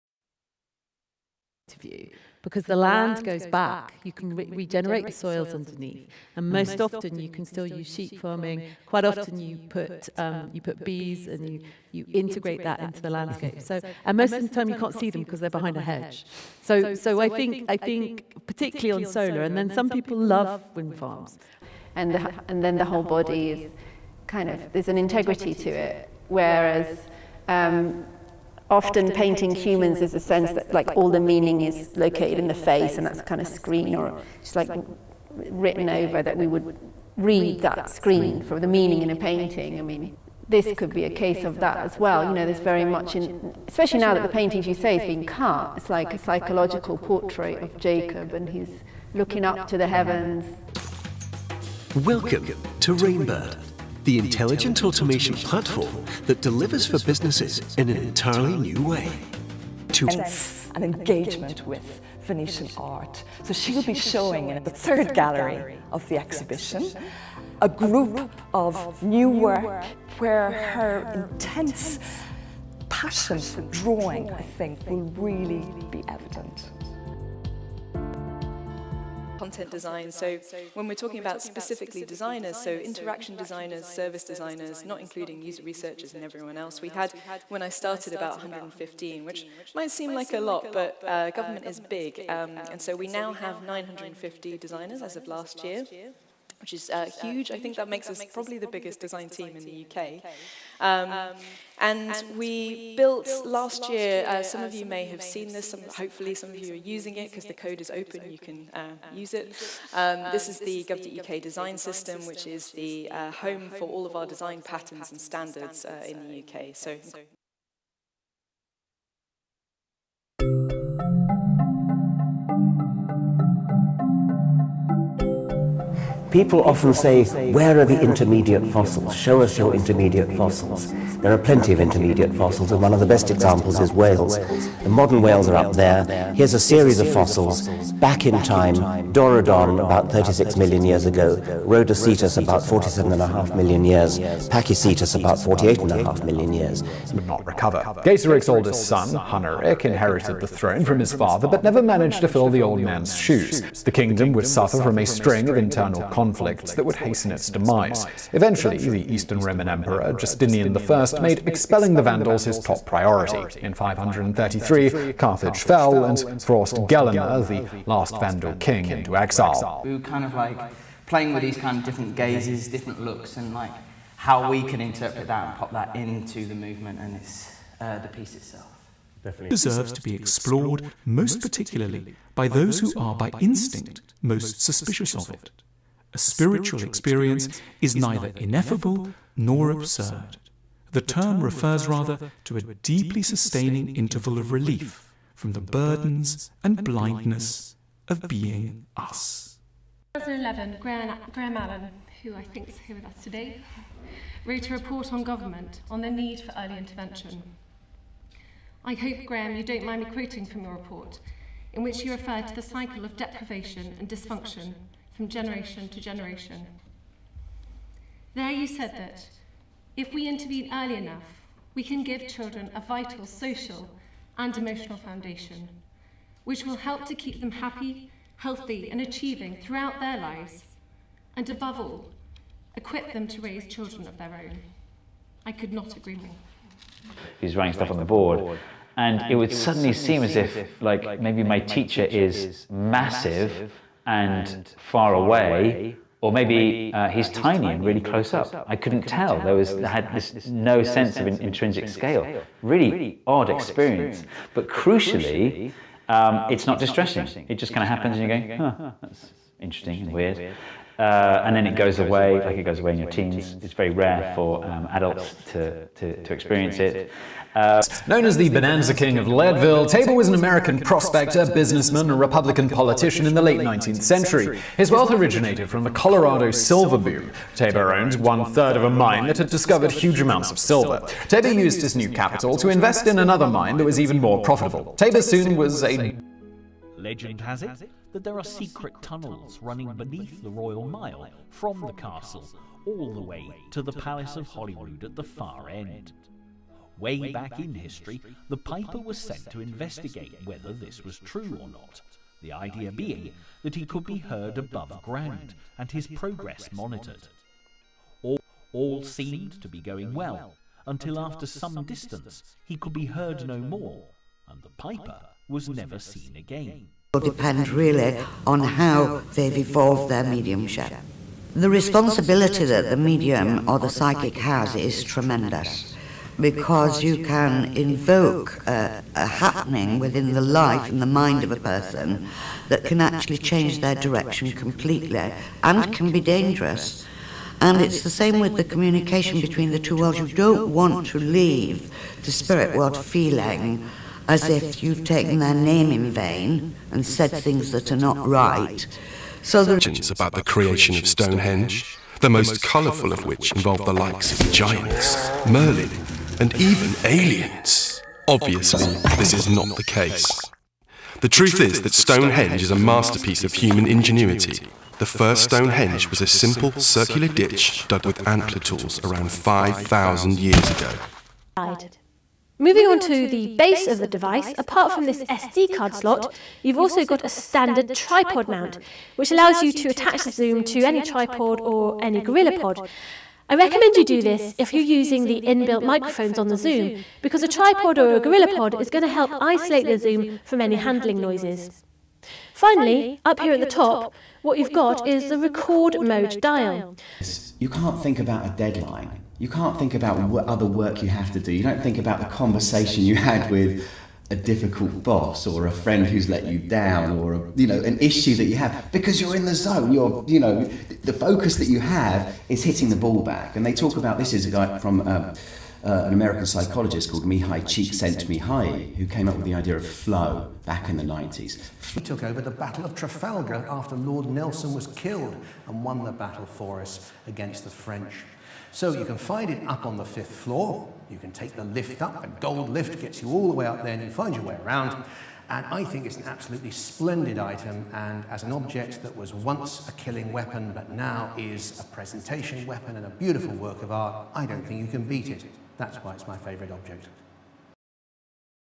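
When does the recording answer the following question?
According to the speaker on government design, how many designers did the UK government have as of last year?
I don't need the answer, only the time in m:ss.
1:33.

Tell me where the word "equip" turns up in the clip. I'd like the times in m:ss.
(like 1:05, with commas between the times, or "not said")
3:52.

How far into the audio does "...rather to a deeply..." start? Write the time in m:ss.
3:11.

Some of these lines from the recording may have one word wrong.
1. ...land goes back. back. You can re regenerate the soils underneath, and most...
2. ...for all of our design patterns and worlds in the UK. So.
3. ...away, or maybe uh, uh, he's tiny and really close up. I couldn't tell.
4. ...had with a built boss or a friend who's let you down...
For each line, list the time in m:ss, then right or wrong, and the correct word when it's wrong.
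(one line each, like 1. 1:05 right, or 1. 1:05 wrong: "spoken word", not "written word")
1. 0:03 right
2. 1:53 wrong: "standards", not "worlds"
3. 4:05 right
4. 6:43 wrong: "difficult", not "built".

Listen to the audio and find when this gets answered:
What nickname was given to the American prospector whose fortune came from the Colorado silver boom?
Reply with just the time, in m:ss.
4:28.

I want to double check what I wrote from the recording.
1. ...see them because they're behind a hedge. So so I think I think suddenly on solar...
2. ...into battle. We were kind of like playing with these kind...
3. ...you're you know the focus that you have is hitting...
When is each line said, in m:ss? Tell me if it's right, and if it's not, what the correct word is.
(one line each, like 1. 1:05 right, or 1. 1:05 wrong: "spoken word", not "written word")
1. 0:14 wrong: "particularly", not "suddenly"
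2. 2:48 wrong: "exile", not "battle"
3. 6:49 right.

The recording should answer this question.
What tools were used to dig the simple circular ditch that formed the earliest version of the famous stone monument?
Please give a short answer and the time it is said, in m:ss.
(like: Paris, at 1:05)
antler tools, at 6:08.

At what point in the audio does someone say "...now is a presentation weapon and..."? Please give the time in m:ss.
7:20.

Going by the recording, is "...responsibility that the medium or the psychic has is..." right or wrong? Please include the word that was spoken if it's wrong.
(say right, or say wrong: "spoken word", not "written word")
right.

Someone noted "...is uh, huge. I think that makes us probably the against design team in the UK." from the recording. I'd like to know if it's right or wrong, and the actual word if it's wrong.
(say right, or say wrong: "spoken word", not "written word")
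wrong: "biggest", not "against".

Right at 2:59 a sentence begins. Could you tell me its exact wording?
deserves to be explored most particularly by those who are by instinct most suspicious of it.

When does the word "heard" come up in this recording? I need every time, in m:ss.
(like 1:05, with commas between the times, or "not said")
5:04, 5:13.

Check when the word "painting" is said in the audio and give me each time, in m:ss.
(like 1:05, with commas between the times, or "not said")
0:29, 0:39, 0:44.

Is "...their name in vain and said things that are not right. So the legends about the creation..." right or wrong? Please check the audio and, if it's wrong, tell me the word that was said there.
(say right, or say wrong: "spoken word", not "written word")
right.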